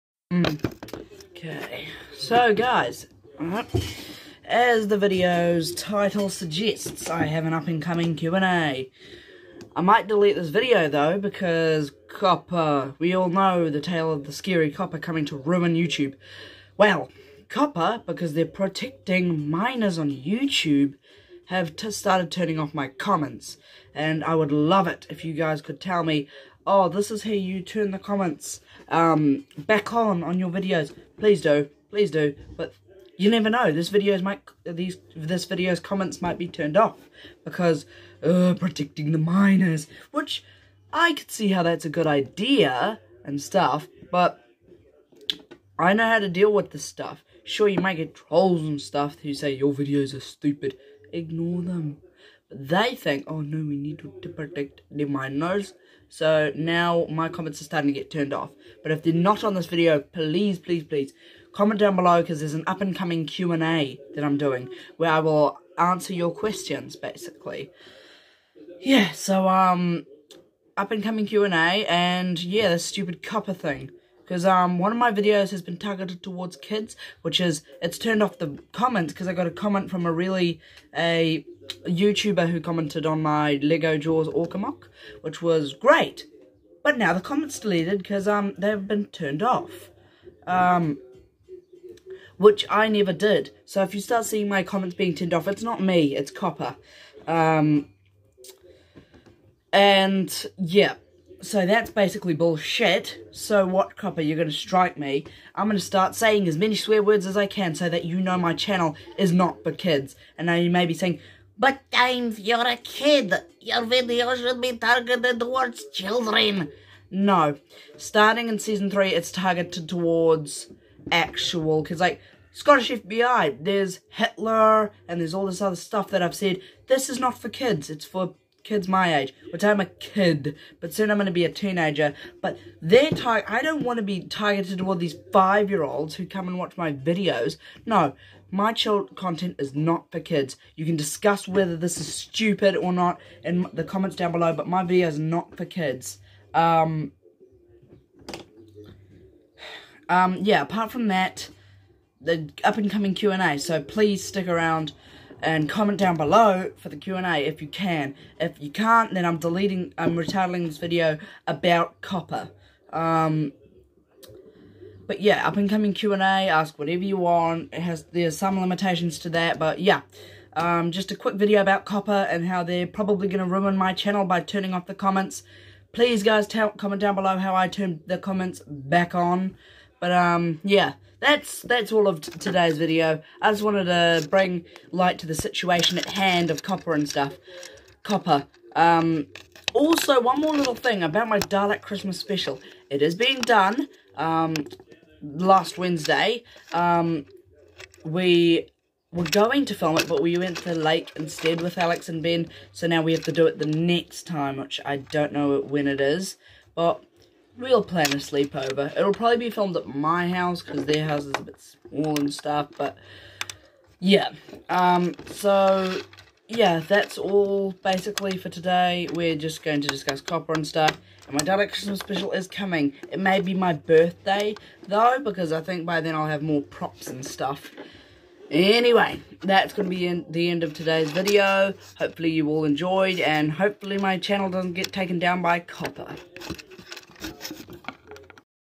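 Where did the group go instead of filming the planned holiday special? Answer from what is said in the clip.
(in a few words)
the lake.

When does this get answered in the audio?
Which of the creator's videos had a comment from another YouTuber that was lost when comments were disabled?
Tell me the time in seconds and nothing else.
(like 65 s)
83 s.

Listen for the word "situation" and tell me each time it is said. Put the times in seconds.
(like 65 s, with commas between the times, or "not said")
185 s.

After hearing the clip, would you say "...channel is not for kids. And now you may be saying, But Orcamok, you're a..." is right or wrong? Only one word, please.
wrong.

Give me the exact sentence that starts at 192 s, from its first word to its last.
It is being done um, last Wednesday.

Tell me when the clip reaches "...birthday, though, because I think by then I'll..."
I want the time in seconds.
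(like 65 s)
223 s.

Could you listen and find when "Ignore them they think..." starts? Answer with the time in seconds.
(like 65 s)
51 s.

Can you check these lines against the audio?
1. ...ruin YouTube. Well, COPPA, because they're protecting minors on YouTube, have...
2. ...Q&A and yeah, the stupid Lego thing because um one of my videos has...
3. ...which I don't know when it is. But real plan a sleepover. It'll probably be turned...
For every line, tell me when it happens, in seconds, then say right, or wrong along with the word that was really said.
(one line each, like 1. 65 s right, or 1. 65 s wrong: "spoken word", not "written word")
1. 15 s right
2. 71 s wrong: "COPPA", not "Lego"
3. 204 s wrong: "filmed", not "turned".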